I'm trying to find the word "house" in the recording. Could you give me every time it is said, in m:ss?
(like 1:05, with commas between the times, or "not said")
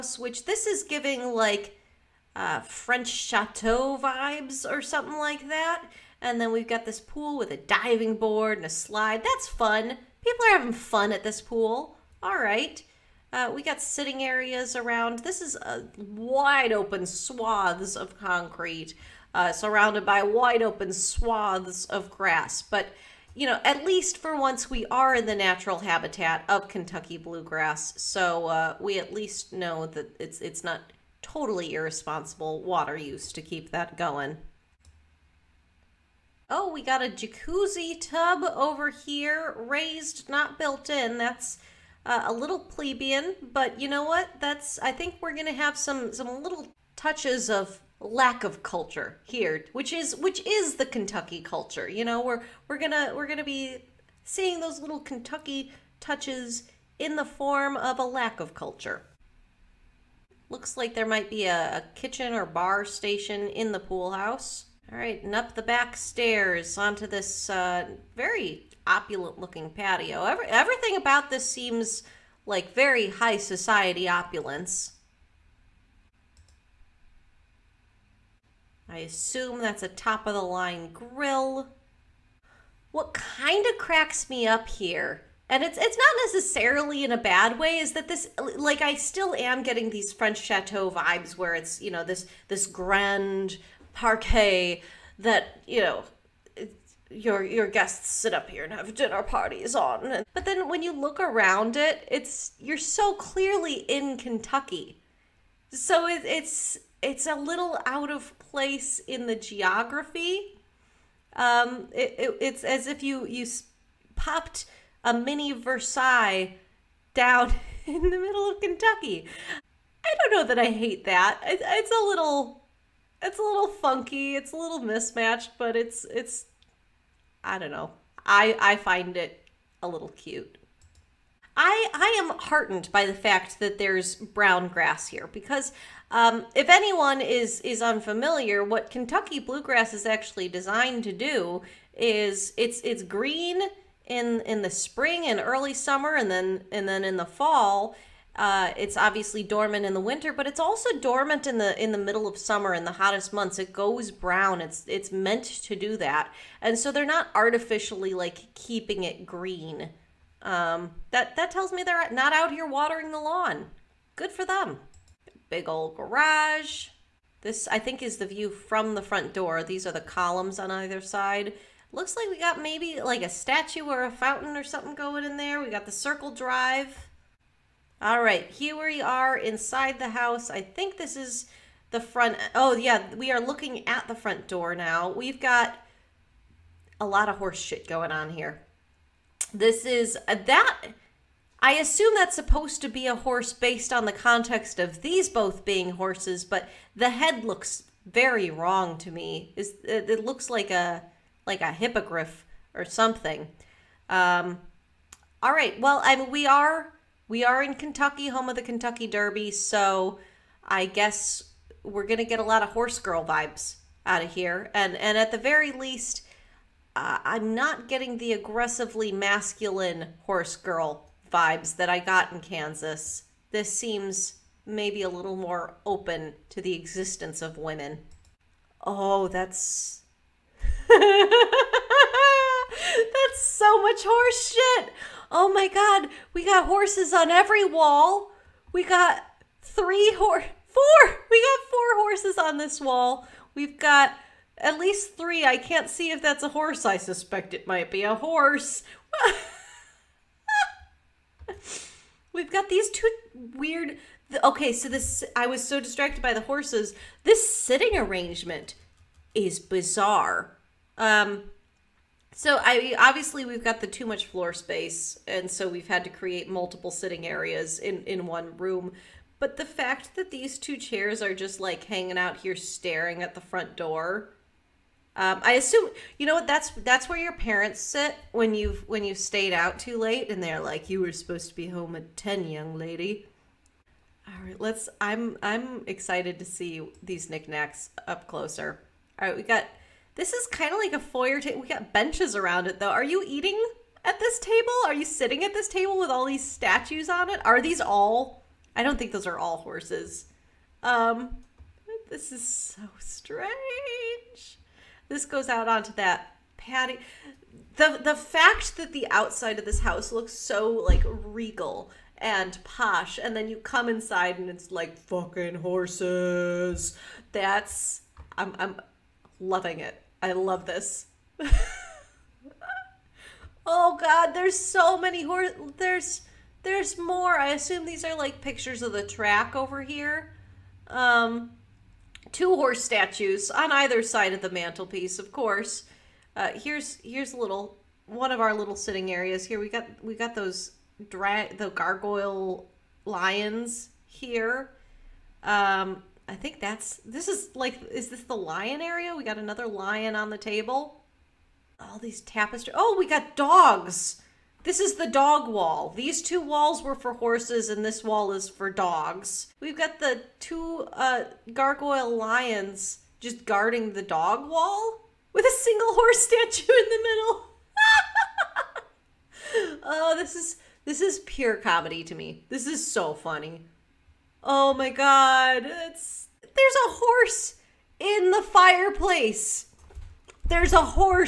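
1:04, 3:00, 5:09.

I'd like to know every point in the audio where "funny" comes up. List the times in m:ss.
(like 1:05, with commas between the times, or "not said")
6:13.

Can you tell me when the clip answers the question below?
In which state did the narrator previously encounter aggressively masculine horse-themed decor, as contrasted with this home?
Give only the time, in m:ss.
3:42.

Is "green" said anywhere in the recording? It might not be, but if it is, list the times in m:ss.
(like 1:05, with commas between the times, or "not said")
2:23, 2:39.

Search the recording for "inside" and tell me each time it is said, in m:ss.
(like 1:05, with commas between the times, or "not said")
2:59, 5:13.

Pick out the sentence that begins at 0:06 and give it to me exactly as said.
And then we've got this pool with a diving board and a slide.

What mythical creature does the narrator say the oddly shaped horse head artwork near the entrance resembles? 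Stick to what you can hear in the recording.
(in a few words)
hippogriff.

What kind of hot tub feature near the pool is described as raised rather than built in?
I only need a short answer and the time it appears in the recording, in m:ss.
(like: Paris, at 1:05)
jacuzzi tub, at 0:37.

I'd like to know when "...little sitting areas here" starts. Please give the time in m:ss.
5:38.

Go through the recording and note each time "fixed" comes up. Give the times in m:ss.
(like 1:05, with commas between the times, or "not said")
not said.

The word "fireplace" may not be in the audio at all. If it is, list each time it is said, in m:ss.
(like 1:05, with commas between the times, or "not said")
6:18.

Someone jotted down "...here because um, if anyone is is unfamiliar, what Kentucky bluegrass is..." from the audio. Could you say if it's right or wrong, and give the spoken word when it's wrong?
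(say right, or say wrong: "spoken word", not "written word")
right.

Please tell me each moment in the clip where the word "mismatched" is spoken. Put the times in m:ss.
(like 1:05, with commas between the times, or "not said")
2:04.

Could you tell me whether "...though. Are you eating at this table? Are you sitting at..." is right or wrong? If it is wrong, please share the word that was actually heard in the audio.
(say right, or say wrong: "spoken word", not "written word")
right.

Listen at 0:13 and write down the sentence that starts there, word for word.
Uh, we got sitting areas around.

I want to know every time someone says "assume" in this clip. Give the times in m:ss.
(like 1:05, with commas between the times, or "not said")
1:18, 3:11, 4:35, 5:27.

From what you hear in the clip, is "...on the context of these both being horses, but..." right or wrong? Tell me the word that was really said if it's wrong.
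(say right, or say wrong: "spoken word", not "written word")
right.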